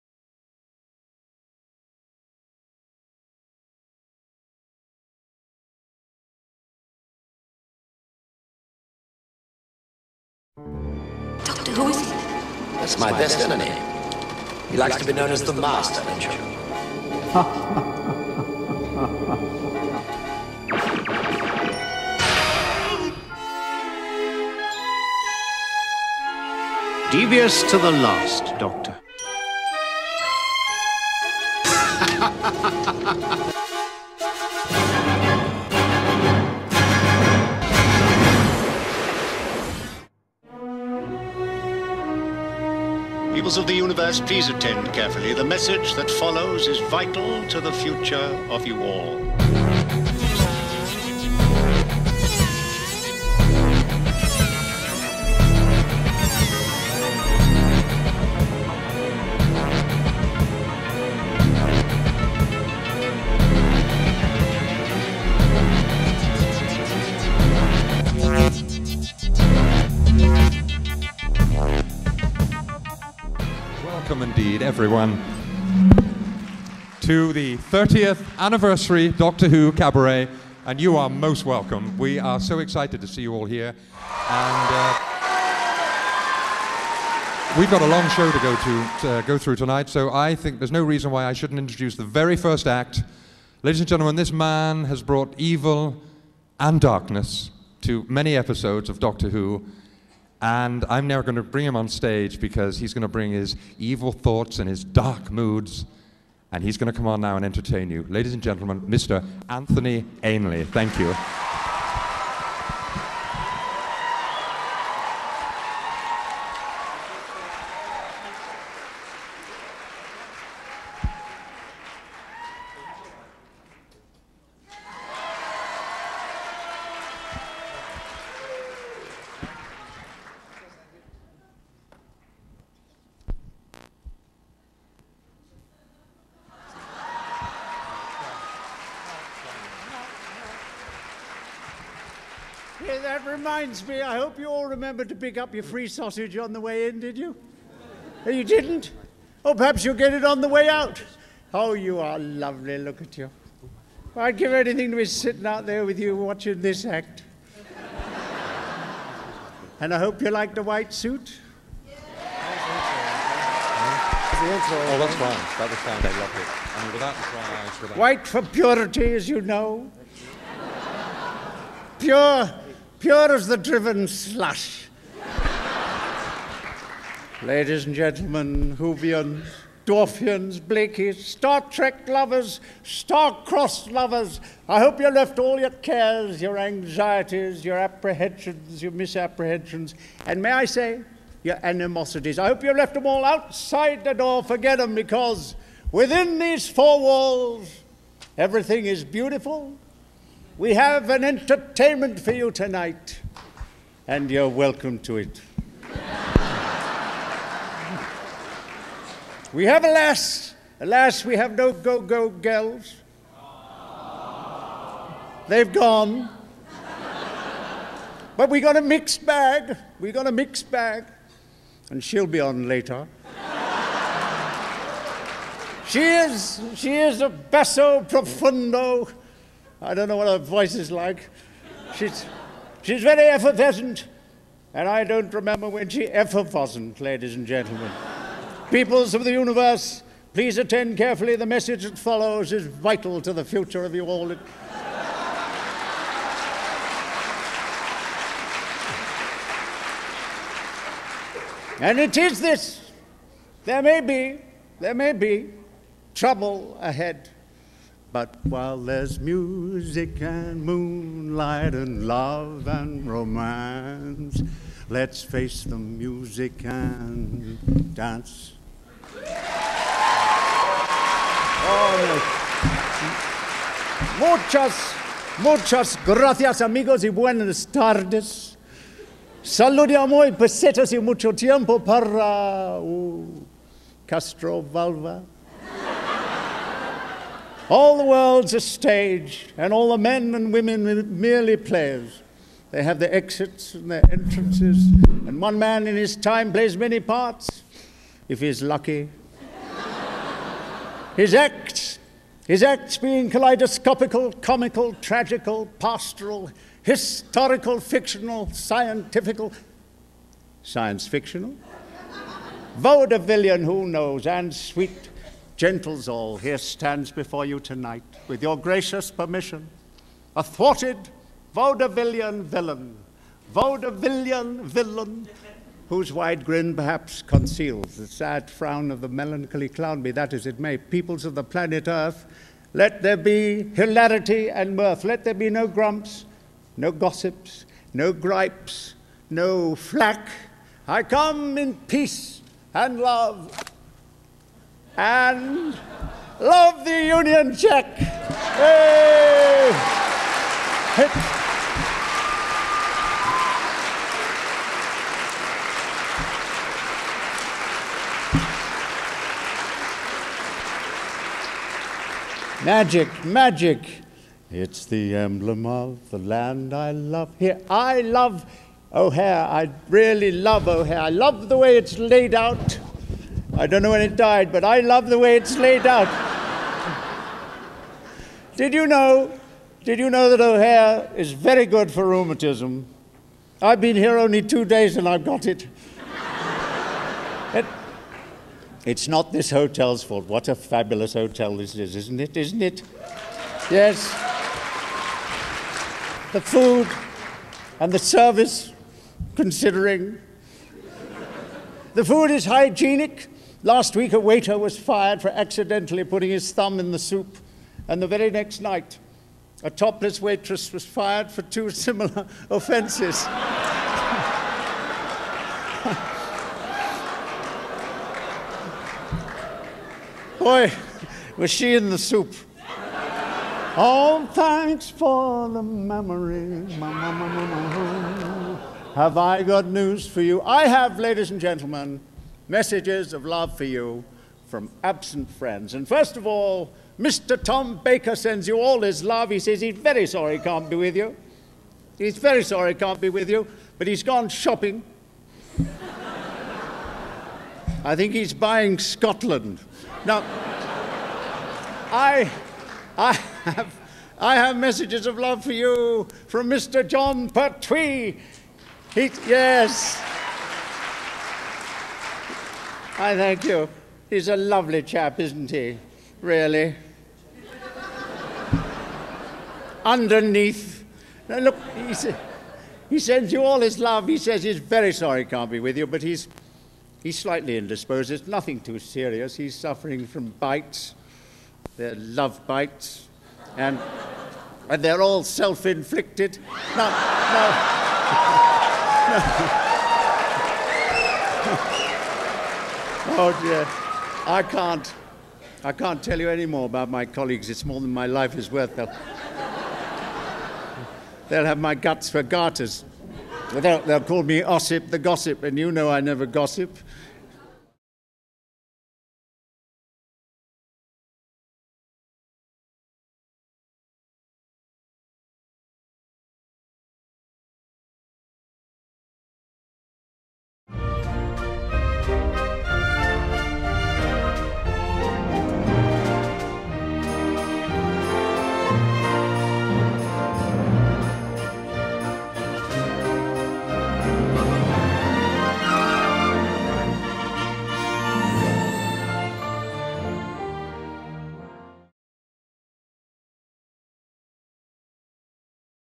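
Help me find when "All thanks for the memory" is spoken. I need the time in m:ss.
7:03.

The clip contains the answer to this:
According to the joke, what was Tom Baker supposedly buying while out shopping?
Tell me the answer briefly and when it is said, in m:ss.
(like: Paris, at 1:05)
Scotland, at 7:28.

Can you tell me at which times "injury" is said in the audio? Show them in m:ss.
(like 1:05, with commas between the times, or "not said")
not said.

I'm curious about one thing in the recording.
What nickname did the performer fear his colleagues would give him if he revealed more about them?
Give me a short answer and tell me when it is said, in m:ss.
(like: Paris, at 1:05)
Ossip the Gossip, at 8:24.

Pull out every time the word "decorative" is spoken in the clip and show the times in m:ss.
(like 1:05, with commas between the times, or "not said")
not said.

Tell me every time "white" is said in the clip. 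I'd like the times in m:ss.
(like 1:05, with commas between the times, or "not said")
2:40, 2:47.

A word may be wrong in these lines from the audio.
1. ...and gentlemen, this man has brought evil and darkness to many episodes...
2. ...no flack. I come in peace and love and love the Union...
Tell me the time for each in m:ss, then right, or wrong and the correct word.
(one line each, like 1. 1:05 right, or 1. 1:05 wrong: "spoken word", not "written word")
1. 1:33 right
2. 5:39 right.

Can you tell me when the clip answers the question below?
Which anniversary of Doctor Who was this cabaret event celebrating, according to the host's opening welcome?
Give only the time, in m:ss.
1:17.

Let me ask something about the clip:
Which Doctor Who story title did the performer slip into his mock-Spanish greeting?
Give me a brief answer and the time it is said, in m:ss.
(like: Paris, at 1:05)
Castrovalva, at 4:44.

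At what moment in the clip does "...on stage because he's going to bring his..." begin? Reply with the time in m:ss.
1:41.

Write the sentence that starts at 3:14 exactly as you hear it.
Forget them, because within these four walls, everything is beautiful, we have an entertainment for you tonight, and you're welcome to it.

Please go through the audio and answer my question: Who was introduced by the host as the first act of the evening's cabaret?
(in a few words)
Anthony Ainley.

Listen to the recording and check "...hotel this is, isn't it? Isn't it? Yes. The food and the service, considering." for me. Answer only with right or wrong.
right.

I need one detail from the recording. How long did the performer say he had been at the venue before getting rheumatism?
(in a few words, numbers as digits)
2 days.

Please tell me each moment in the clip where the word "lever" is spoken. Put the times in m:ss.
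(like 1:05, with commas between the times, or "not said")
not said.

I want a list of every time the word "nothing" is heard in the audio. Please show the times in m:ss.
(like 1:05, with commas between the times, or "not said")
7:58.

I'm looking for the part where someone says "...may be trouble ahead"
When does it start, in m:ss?
4:14.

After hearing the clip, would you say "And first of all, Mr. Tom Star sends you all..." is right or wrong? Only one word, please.
wrong.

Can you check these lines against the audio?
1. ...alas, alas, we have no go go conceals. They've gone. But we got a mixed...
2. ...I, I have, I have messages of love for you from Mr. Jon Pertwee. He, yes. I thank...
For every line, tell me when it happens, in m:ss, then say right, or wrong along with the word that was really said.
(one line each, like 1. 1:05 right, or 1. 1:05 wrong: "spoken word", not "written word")
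1. 3:29 wrong: "girls", not "conceals"
2. 7:31 right.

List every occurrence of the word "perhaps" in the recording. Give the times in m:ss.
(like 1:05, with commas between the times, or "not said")
2:29, 5:26.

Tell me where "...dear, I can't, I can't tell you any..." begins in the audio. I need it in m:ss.
8:13.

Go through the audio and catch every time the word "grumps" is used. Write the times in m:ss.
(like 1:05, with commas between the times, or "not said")
5:35.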